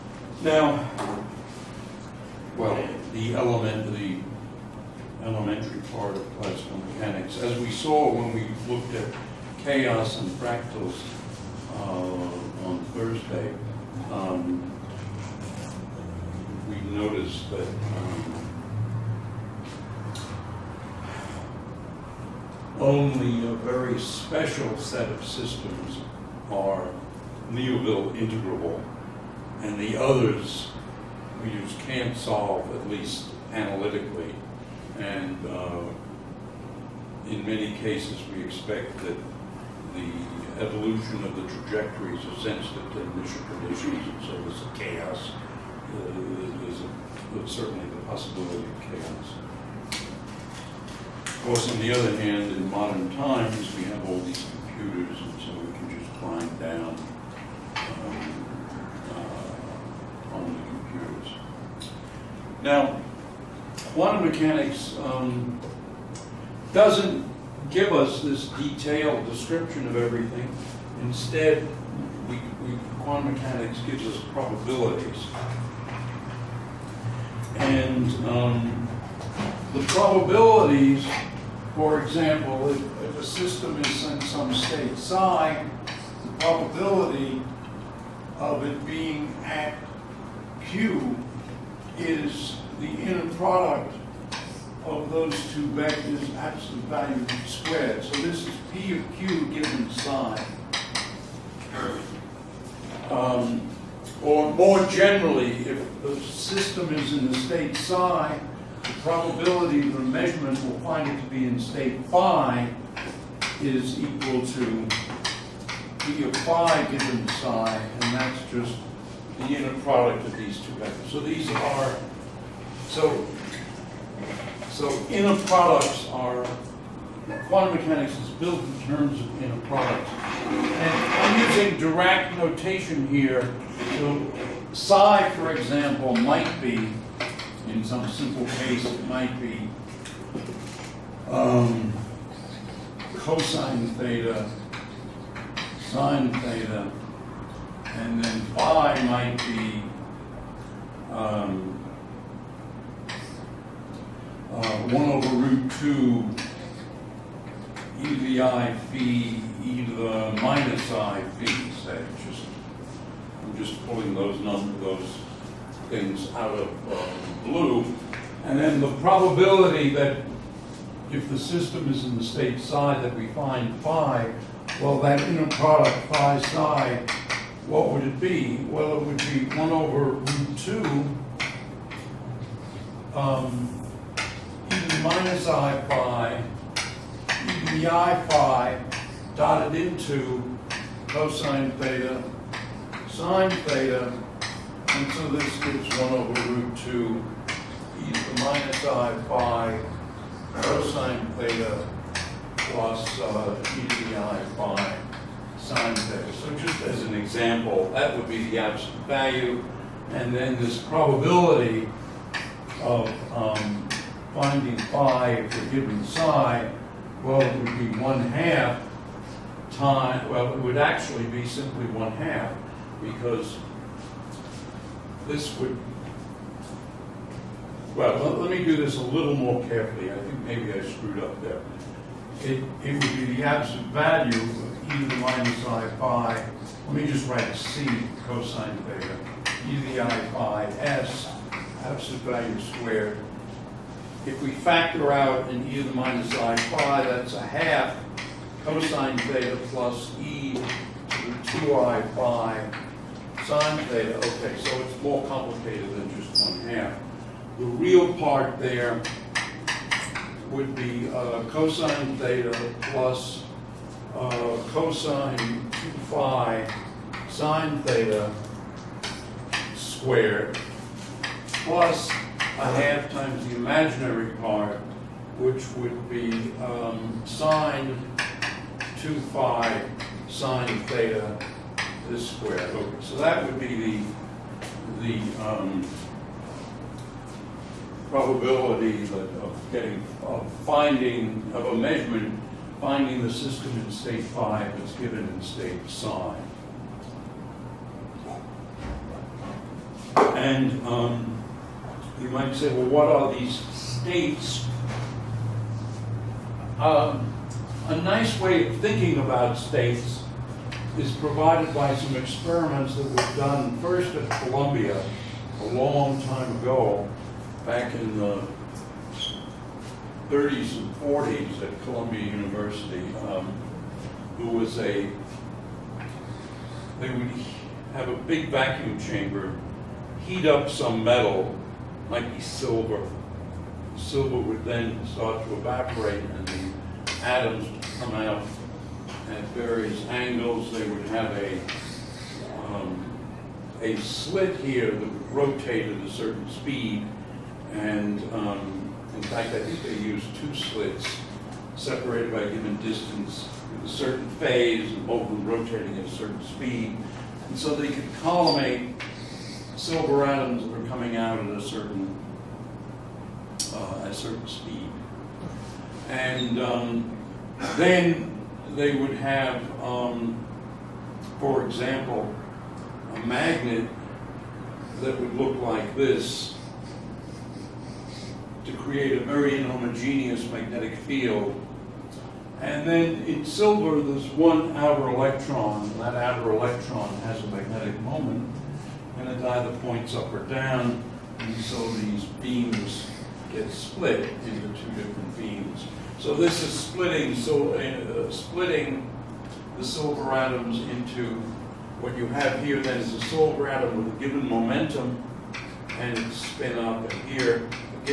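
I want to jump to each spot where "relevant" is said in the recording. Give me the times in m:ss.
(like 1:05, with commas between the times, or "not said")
not said.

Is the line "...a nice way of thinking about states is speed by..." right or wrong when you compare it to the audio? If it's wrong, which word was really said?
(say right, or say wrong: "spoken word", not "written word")
wrong: "provided", not "speed".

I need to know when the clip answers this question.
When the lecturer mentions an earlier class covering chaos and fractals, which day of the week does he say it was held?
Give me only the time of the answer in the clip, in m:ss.
0:12.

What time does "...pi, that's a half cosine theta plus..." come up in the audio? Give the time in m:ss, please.
4:06.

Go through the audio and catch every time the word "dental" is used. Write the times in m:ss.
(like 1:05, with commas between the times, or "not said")
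not said.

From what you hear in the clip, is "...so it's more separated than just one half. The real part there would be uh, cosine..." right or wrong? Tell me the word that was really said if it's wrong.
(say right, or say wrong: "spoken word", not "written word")
wrong: "complicated", not "separated".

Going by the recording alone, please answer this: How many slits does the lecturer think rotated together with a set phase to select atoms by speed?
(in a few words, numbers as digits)
2.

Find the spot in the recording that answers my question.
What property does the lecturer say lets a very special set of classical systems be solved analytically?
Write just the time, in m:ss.
0:27.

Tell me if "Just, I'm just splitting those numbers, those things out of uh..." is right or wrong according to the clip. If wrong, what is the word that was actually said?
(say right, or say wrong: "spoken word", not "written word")
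wrong: "pulling", not "splitting".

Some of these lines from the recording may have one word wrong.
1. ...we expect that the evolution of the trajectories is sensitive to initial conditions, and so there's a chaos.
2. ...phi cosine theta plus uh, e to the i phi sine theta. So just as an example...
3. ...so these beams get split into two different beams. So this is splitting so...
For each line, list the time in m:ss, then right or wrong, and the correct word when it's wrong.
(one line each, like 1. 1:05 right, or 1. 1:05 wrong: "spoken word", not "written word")
1. 0:38 right
2. 3:19 right
3. 6:31 right.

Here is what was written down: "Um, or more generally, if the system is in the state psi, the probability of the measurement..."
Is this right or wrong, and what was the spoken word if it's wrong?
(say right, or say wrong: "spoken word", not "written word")
right.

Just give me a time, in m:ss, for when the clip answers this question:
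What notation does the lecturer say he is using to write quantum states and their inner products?
2:11.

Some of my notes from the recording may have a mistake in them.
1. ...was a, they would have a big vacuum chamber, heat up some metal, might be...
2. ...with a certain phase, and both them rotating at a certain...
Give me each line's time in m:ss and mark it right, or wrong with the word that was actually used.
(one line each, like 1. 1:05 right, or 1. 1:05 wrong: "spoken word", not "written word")
1. 5:24 right
2. 5:53 right.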